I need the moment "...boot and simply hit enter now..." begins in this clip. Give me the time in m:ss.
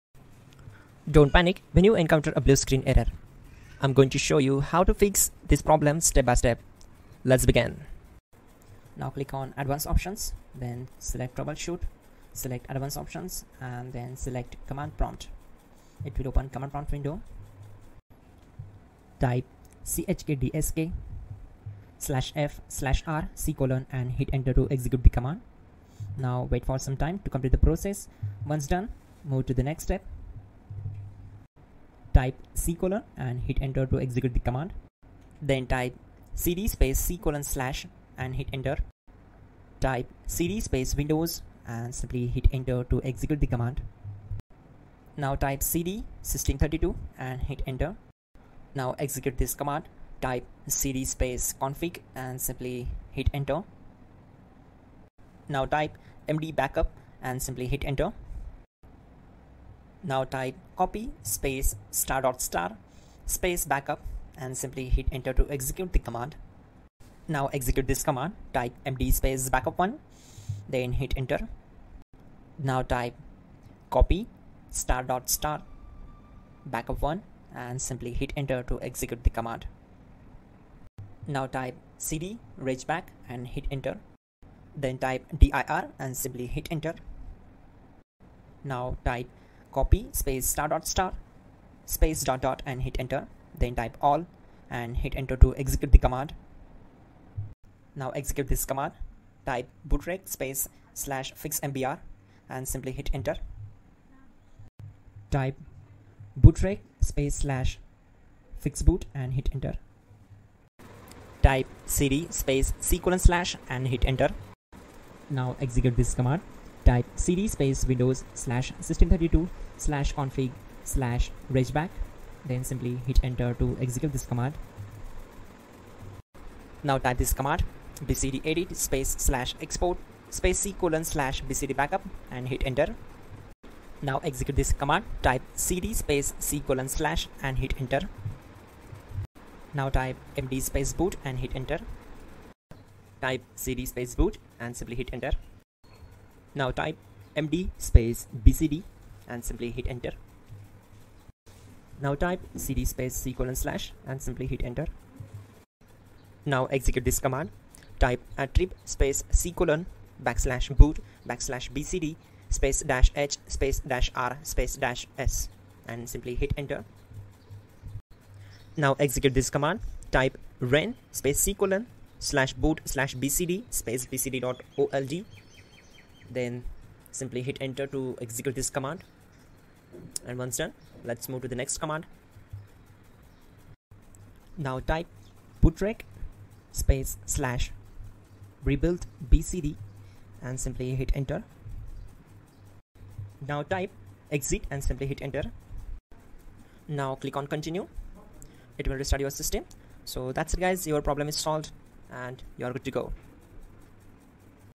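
2:24.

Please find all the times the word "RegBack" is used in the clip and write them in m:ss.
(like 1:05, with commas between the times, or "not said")
1:22, 2:01.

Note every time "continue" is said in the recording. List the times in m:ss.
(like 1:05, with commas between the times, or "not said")
3:17.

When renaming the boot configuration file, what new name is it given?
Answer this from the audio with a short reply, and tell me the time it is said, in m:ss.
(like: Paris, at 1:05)
bcd.old, at 2:54.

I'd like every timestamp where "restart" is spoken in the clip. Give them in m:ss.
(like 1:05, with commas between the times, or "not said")
3:18.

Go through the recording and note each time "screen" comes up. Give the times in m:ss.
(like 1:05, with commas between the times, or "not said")
0:02.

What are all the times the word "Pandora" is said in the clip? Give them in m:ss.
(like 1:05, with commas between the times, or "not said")
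not said.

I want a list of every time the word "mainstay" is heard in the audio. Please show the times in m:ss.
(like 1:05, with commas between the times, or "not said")
not said.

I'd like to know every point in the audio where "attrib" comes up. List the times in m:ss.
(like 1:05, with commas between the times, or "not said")
2:38.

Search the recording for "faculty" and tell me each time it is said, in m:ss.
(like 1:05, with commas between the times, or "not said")
not said.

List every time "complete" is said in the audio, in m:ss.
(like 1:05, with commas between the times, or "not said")
0:27.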